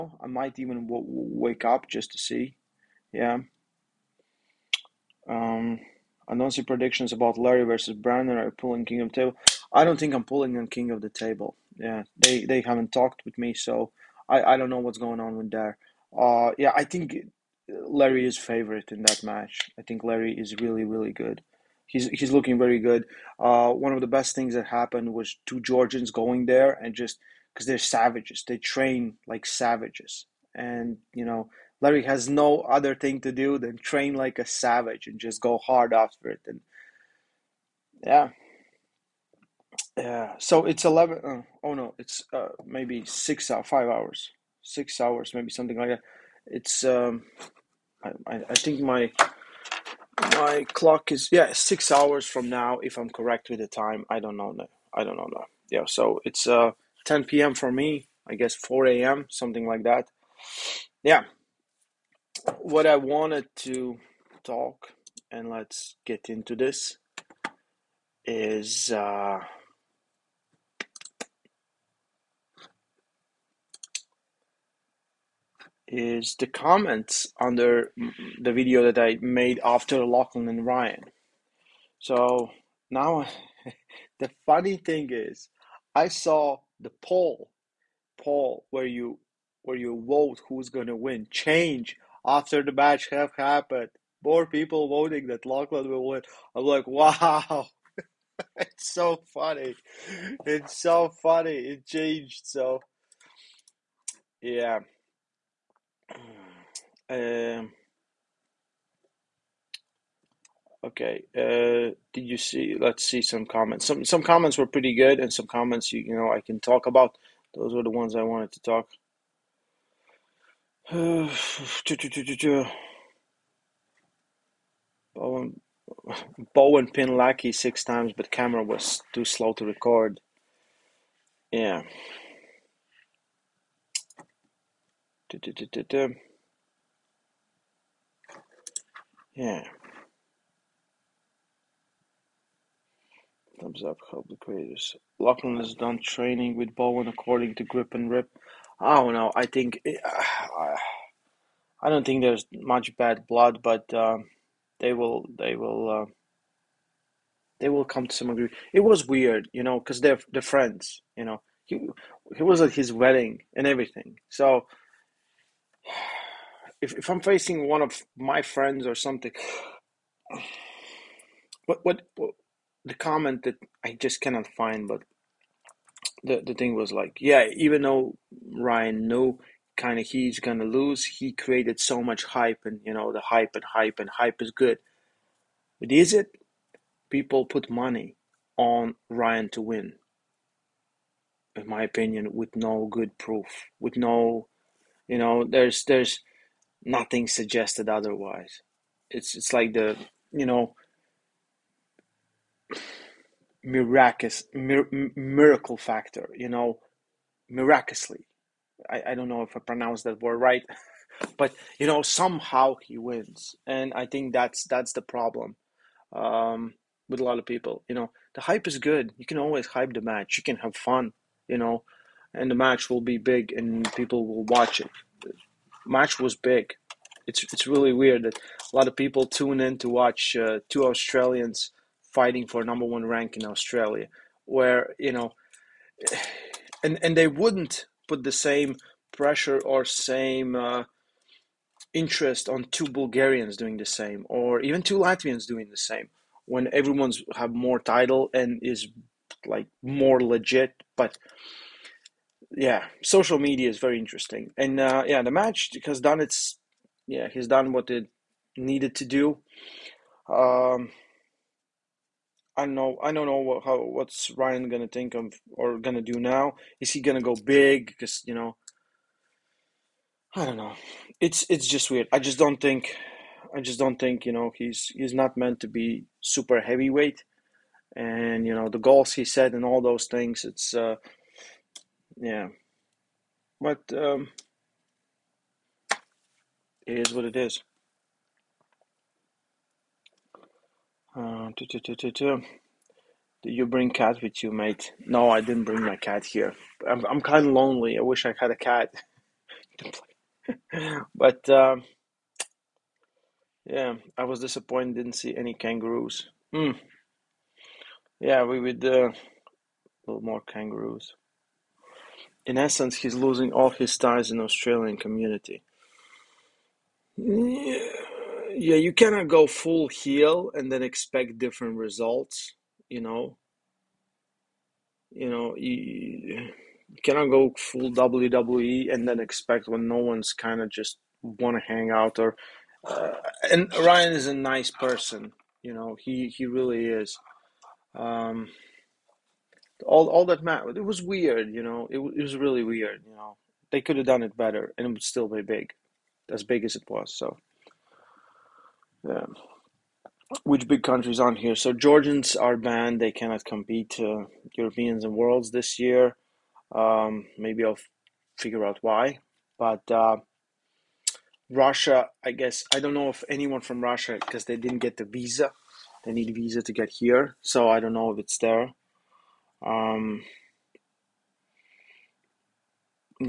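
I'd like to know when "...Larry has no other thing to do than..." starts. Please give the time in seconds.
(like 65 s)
31 s.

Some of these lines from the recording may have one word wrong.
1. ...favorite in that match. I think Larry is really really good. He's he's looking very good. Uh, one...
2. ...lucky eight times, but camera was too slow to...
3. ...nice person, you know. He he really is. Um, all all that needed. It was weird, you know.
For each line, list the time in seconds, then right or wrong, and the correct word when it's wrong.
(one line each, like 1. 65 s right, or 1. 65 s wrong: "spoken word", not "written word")
1. 18 s right
2. 127 s wrong: "six", not "eight"
3. 334 s wrong: "mattered", not "needed".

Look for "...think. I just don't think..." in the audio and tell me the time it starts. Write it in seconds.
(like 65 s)
272 s.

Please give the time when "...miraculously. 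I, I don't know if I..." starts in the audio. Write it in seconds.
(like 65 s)
207 s.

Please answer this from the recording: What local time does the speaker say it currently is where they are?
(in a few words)
10 p.m.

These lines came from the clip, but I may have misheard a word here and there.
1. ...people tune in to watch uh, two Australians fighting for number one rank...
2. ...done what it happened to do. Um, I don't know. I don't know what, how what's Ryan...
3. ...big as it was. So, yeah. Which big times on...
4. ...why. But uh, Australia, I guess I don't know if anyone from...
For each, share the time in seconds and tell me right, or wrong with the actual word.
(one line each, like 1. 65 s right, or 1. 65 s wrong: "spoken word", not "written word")
1. 228 s right
2. 257 s wrong: "needed", not "happened"
3. 346 s wrong: "countries", not "times"
4. 358 s wrong: "Russia", not "Australia".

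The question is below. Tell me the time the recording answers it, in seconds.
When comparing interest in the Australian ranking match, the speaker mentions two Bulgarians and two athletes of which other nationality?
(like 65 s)
244 s.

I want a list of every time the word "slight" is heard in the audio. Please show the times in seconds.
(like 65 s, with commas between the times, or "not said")
not said.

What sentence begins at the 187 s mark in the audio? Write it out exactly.
People put money on Ryan to win.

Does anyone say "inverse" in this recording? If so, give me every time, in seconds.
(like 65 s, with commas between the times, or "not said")
not said.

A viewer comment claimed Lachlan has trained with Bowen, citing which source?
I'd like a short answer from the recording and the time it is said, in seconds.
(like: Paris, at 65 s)
Grip and Rip, at 147 s.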